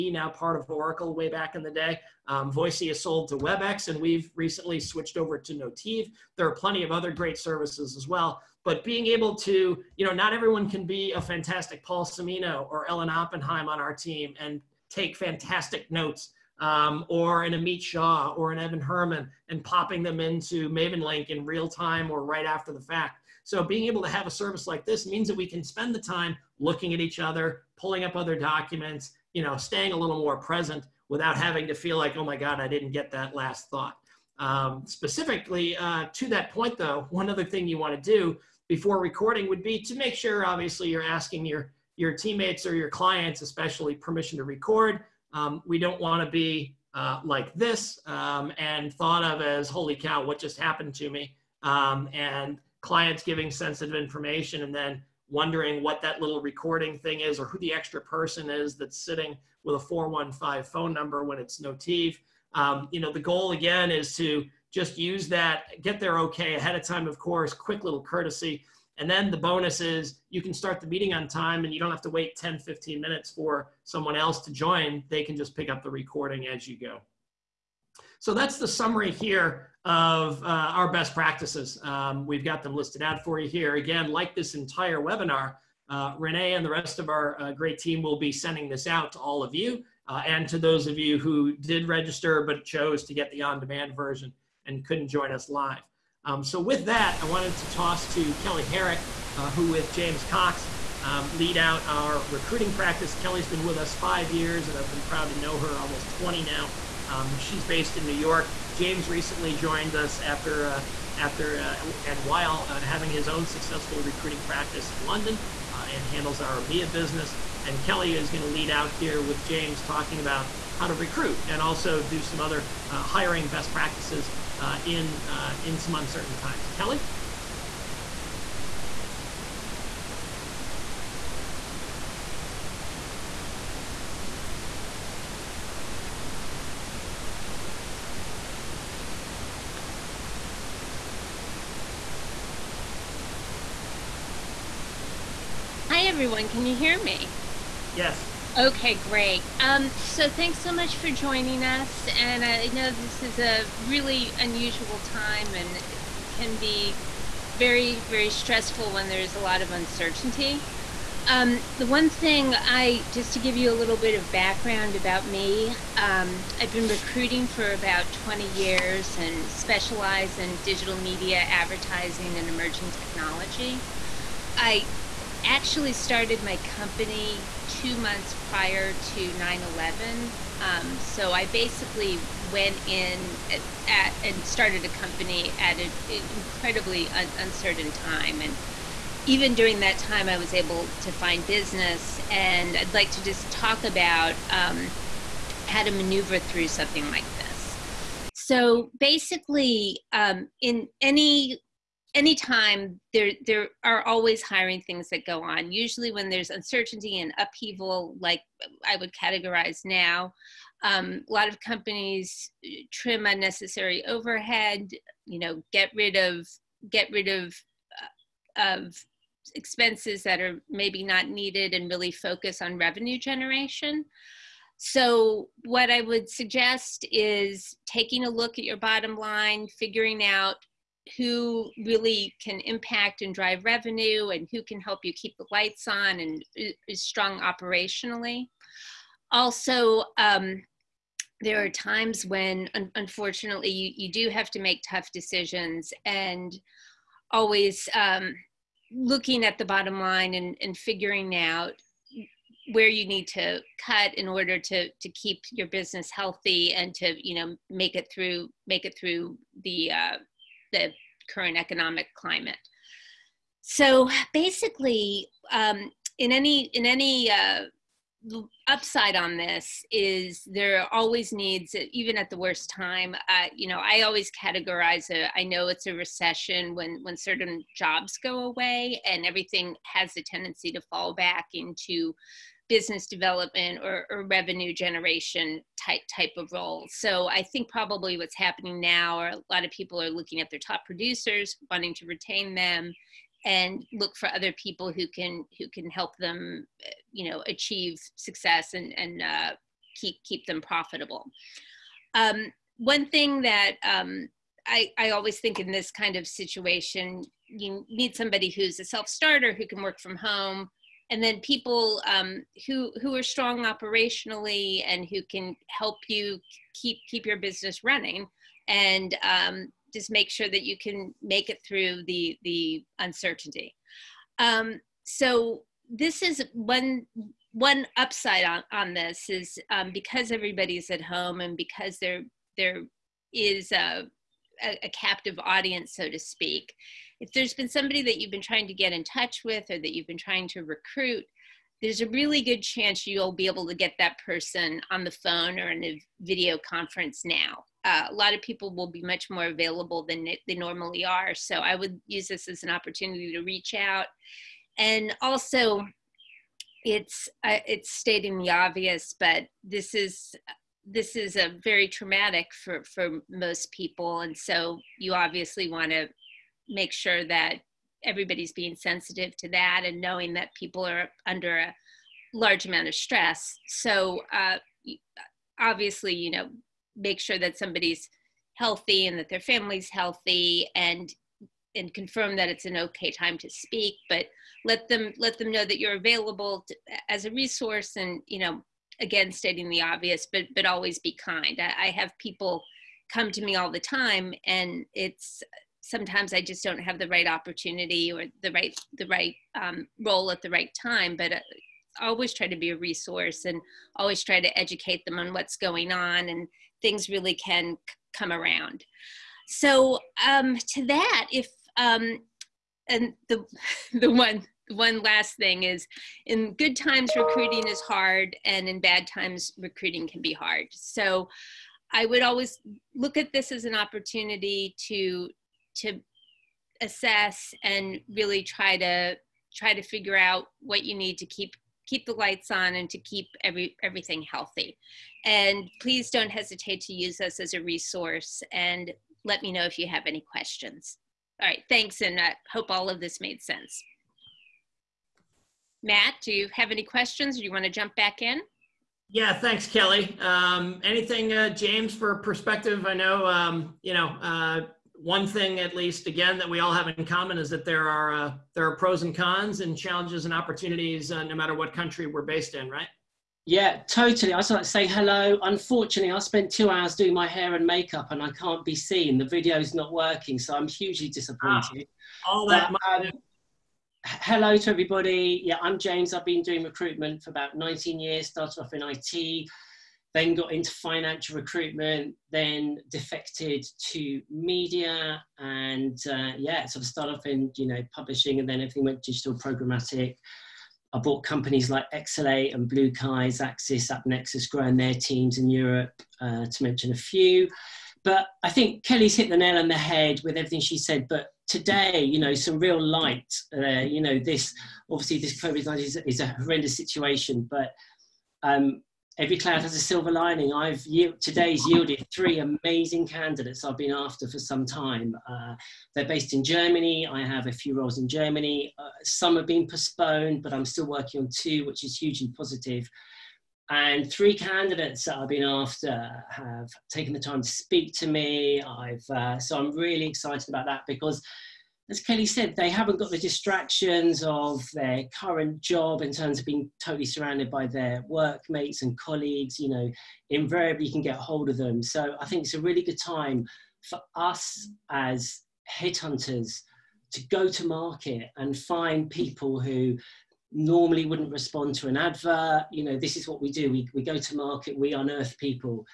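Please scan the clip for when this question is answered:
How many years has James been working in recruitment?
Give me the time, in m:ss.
7:57.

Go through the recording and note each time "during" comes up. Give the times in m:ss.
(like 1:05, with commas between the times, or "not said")
3:09.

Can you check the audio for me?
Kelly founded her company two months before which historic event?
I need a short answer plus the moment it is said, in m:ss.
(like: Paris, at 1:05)
9/11, at 2:59.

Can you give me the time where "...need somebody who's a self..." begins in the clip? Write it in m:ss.
5:07.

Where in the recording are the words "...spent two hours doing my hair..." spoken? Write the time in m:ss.
7:46.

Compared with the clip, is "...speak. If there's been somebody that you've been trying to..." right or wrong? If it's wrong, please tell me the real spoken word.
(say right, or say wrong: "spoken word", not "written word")
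right.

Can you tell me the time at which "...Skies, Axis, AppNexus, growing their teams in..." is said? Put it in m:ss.
8:12.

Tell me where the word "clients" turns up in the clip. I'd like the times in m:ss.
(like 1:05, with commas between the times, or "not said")
0:42, 0:52.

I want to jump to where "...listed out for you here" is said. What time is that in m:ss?
1:22.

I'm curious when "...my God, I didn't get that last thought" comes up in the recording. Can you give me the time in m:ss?
0:32.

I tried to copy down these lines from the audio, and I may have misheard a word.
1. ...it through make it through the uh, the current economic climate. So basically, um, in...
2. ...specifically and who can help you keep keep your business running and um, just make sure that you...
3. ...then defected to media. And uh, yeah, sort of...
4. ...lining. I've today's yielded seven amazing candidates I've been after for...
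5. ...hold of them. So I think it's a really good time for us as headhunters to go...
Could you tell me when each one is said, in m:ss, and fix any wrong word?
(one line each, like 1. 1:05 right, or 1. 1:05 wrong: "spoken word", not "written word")
1. 4:17 right
2. 5:13 wrong: "operationally", not "specifically"
3. 8:02 right
4. 8:30 wrong: "three", not "seven"
5. 9:01 right.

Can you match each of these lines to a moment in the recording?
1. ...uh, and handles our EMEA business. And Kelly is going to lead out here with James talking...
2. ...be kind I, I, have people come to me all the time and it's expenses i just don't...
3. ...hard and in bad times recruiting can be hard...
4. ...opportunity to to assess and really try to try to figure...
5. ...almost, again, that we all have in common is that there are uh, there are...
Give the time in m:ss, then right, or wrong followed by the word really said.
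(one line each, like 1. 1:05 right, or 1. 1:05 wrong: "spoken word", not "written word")
1. 1:55 right
2. 6:30 wrong: "sometimes", not "expenses"
3. 6:57 right
4. 7:03 right
5. 7:35 wrong: "least", not "almost".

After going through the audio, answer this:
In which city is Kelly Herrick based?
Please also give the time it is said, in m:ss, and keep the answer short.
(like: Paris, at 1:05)
New York, at 1:48.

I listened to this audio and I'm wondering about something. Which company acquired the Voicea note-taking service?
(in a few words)
WebEx.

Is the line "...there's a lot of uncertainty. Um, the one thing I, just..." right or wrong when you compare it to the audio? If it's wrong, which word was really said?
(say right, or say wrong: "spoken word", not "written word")
right.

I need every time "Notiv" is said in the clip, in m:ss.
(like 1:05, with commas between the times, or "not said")
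0:05, 1:01.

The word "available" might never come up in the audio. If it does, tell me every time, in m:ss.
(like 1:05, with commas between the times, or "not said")
5:49, 6:25.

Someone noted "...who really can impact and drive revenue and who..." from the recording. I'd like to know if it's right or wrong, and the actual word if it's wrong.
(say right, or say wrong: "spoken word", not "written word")
right.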